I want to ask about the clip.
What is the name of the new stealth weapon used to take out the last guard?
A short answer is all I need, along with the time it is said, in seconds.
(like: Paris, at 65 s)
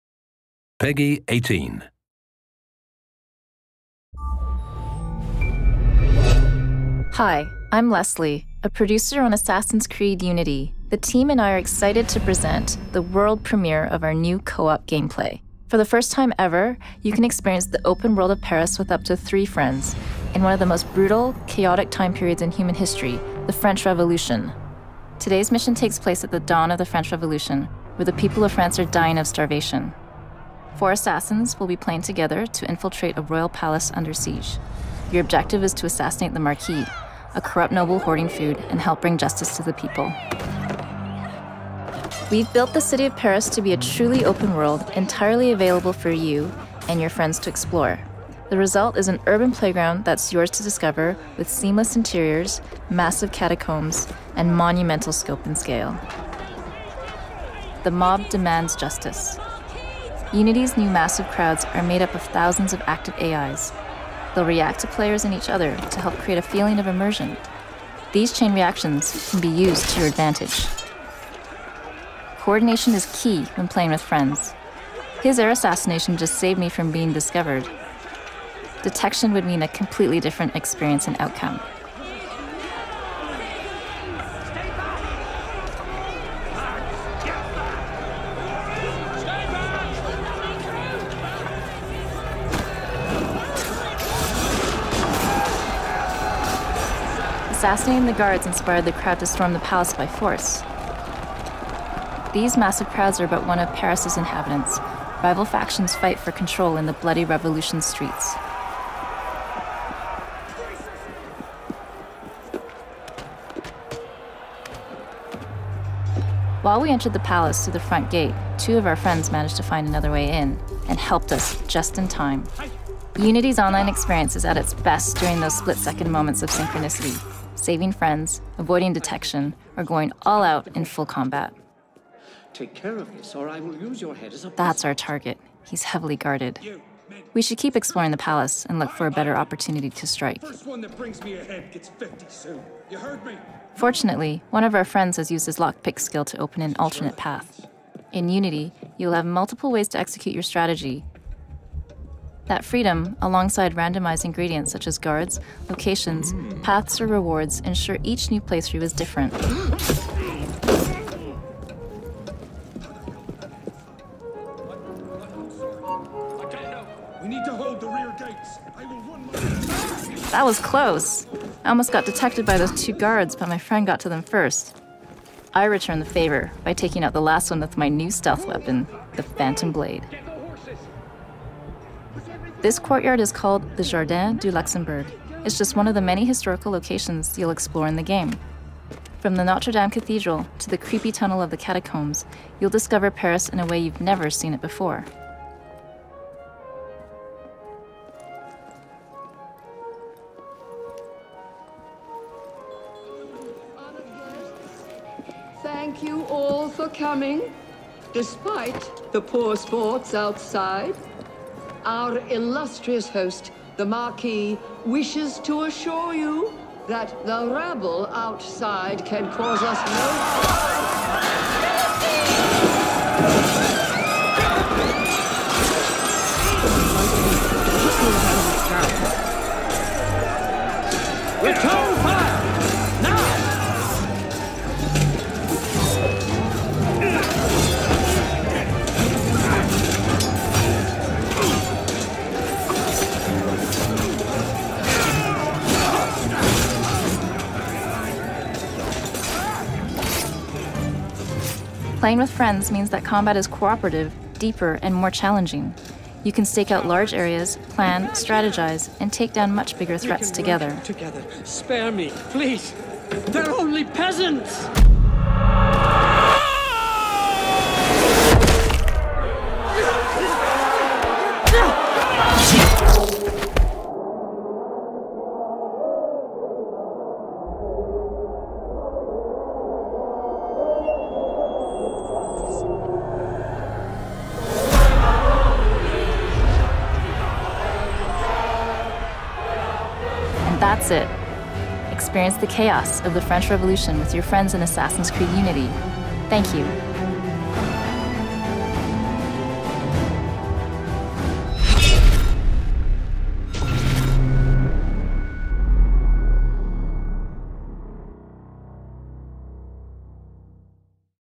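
Phantom Blade, at 179 s.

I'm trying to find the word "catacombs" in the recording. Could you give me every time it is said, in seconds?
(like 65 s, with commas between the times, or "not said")
53 s, 191 s.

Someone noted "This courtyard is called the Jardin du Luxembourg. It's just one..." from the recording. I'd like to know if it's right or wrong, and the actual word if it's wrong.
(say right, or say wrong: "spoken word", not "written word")
right.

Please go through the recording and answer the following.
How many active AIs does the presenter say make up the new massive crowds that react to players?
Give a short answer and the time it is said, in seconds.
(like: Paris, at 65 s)
Thousands, at 62 s.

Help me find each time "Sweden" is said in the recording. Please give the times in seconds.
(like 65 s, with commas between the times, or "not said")
not said.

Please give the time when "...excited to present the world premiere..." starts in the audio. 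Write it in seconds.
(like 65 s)
11 s.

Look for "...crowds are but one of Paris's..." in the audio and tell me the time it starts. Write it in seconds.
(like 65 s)
102 s.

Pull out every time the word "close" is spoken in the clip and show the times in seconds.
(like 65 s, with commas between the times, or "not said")
170 s.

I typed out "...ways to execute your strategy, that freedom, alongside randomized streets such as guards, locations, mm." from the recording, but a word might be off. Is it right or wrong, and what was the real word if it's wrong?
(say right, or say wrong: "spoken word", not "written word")
wrong: "ingredients", not "streets".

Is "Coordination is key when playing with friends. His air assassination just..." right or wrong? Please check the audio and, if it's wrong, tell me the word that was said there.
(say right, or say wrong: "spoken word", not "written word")
right.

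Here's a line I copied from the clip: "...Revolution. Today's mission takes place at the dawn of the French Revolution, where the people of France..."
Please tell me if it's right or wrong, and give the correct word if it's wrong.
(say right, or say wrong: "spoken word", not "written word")
right.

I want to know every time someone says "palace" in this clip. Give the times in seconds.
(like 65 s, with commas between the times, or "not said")
33 s, 99 s, 117 s, 138 s.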